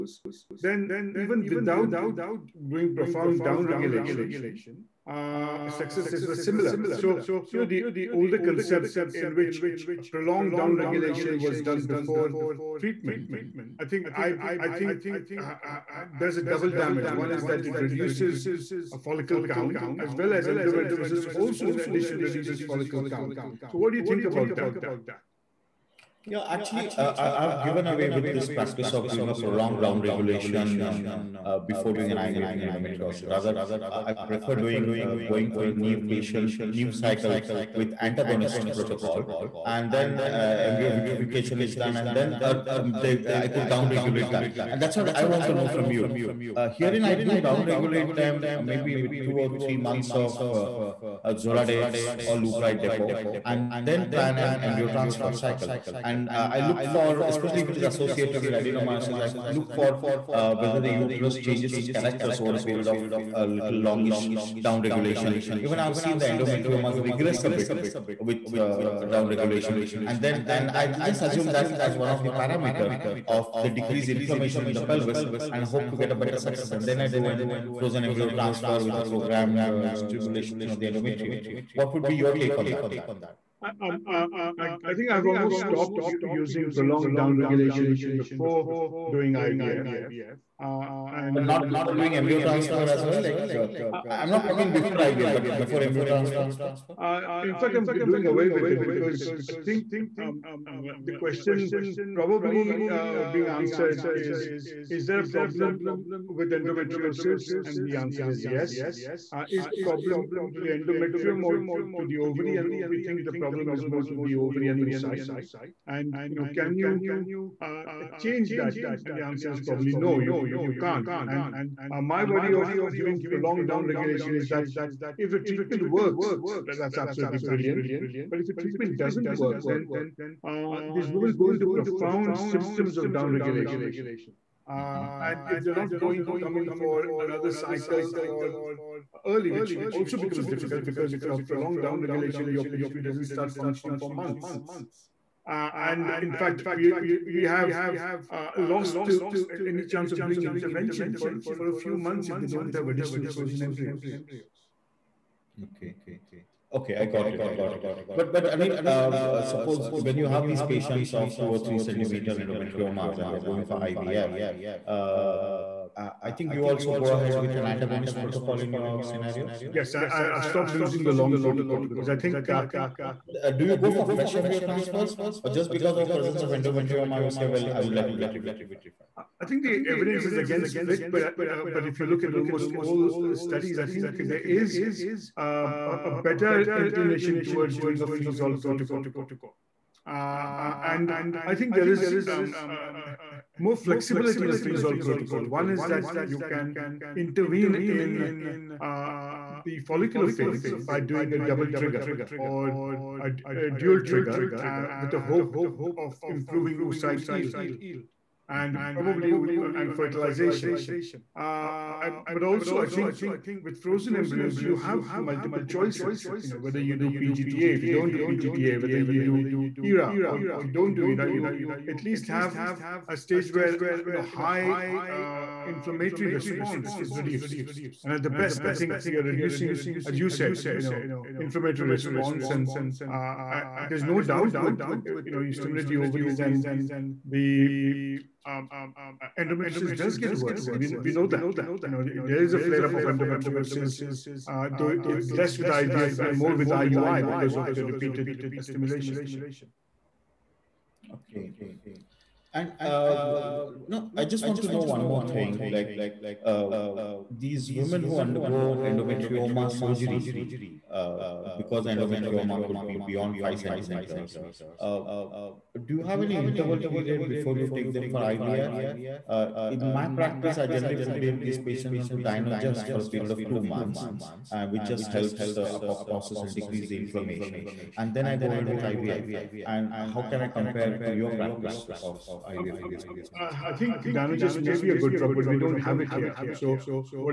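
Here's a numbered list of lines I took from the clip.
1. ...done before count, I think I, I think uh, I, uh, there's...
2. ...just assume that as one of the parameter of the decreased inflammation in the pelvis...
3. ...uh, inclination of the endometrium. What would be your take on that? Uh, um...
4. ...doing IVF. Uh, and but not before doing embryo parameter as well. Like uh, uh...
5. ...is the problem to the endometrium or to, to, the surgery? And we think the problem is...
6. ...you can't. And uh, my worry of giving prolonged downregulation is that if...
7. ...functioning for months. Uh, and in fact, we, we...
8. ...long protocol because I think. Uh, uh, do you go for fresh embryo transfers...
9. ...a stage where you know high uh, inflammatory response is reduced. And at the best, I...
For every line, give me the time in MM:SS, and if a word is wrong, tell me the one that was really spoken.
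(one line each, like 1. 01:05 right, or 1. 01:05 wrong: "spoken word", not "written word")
1. 00:11 wrong: "treatment", not "count"
2. 01:10 right
3. 01:19 wrong: "stimulation", not "inclination"
4. 01:29 wrong: "transfer", not "parameter"
5. 01:49 wrong: "ovary", not "surgery"
6. 02:00 right
7. 02:23 right
8. 02:51 right
9. 03:43 right.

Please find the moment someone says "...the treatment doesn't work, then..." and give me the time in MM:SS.
02:08.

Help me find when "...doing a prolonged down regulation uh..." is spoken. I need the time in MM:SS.
00:29.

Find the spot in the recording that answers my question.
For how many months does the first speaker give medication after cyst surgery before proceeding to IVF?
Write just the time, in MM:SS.
04:33.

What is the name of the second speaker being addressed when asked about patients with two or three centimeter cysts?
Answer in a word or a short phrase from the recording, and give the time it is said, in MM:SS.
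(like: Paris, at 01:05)
Anil, at 02:38.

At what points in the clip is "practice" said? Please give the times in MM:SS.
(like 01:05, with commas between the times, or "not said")
00:28, 04:30, 04:41.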